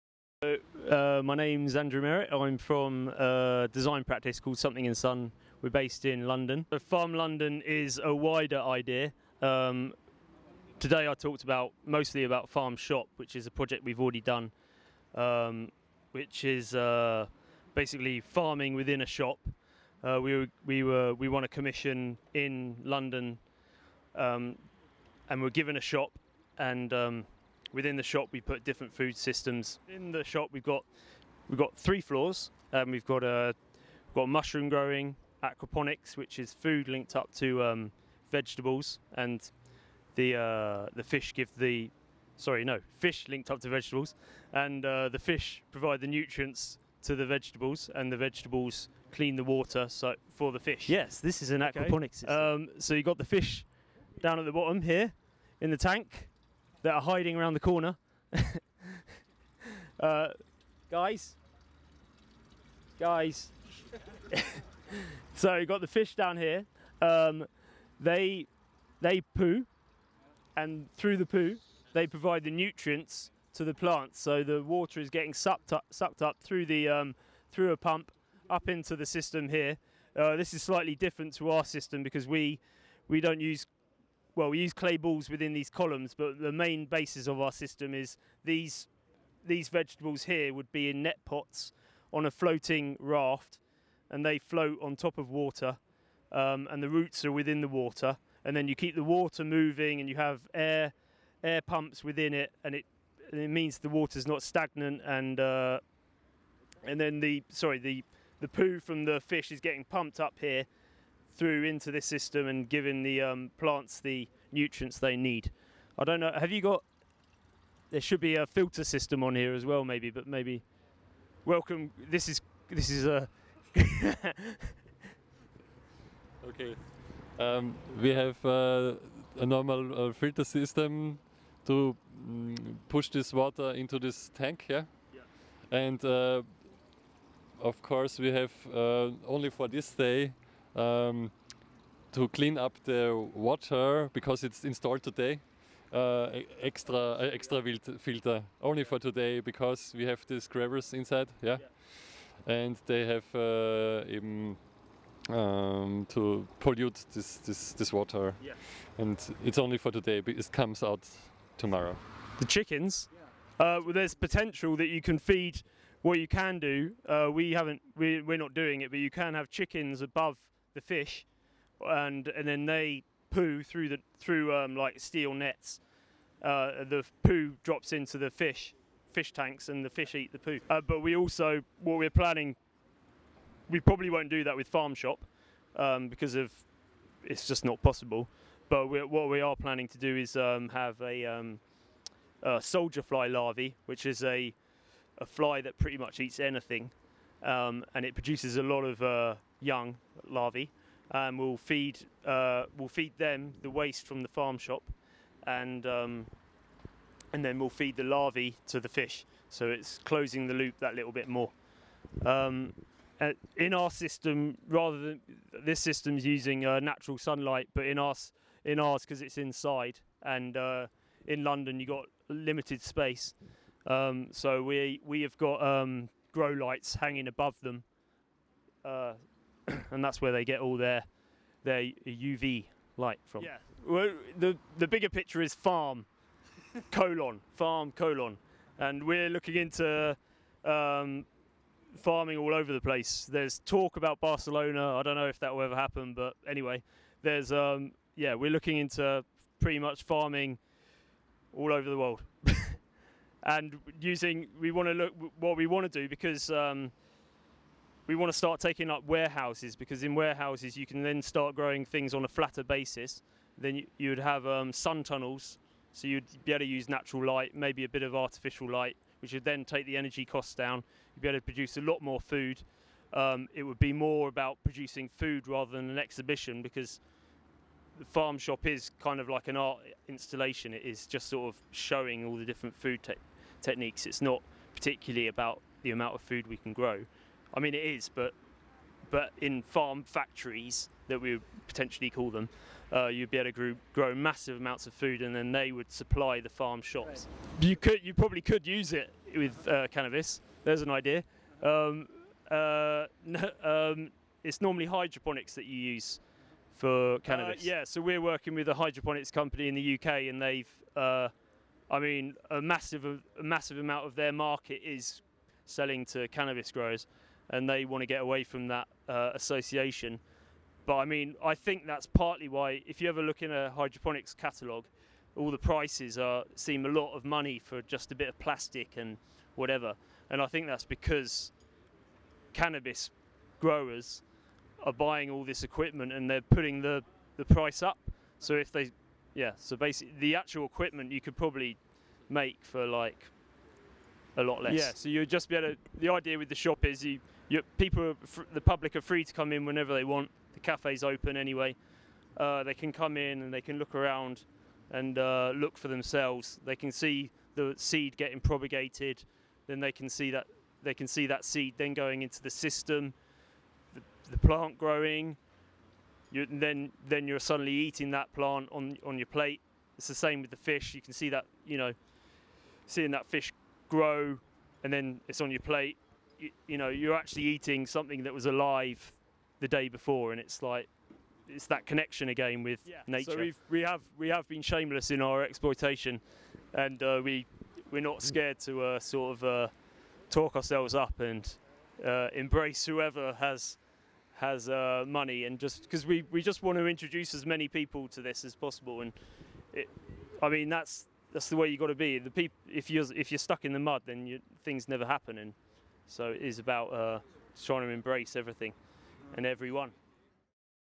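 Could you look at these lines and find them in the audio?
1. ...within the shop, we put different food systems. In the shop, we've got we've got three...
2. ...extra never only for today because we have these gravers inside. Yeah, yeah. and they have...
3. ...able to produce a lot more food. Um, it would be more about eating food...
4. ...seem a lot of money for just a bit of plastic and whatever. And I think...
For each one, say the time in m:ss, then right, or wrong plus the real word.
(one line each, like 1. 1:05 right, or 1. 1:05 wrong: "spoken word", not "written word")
1. 0:27 right
2. 2:27 wrong: "filter", not "never"
3. 4:31 wrong: "producing", not "eating"
4. 5:26 right.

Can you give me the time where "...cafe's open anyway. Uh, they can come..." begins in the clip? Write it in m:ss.
5:50.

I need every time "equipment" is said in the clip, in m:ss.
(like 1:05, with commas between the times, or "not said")
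5:35, 5:40.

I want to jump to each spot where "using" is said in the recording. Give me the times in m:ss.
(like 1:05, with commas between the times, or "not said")
3:36, 4:13.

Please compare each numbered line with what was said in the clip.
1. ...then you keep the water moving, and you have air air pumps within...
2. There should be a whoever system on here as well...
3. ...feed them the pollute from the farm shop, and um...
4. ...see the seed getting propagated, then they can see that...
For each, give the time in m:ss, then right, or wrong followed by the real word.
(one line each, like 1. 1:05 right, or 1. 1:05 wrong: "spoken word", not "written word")
1. 1:38 right
2. 1:57 wrong: "filter", not "whoever"
3. 3:22 wrong: "waste", not "pollute"
4. 5:56 right.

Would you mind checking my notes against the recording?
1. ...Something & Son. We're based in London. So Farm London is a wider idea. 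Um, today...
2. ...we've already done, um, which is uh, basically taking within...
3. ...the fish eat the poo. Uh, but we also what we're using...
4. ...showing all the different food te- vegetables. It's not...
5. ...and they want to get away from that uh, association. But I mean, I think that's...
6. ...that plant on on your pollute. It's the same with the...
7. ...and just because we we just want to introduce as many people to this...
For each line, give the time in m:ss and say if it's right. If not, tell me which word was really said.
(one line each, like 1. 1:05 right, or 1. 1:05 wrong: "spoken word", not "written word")
1. 0:04 right
2. 0:13 wrong: "farming", not "taking"
3. 2:59 wrong: "planning", not "using"
4. 4:41 wrong: "techniques", not "vegetables"
5. 5:17 right
6. 6:08 wrong: "plate", not "pollute"
7. 6:35 right.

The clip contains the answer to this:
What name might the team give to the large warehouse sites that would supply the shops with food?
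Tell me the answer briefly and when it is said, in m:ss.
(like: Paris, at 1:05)
farm factories, at 4:49.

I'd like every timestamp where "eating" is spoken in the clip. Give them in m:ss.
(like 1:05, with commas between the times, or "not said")
6:07, 6:17.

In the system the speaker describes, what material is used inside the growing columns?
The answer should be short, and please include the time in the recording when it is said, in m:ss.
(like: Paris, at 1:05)
clay balls, at 1:24.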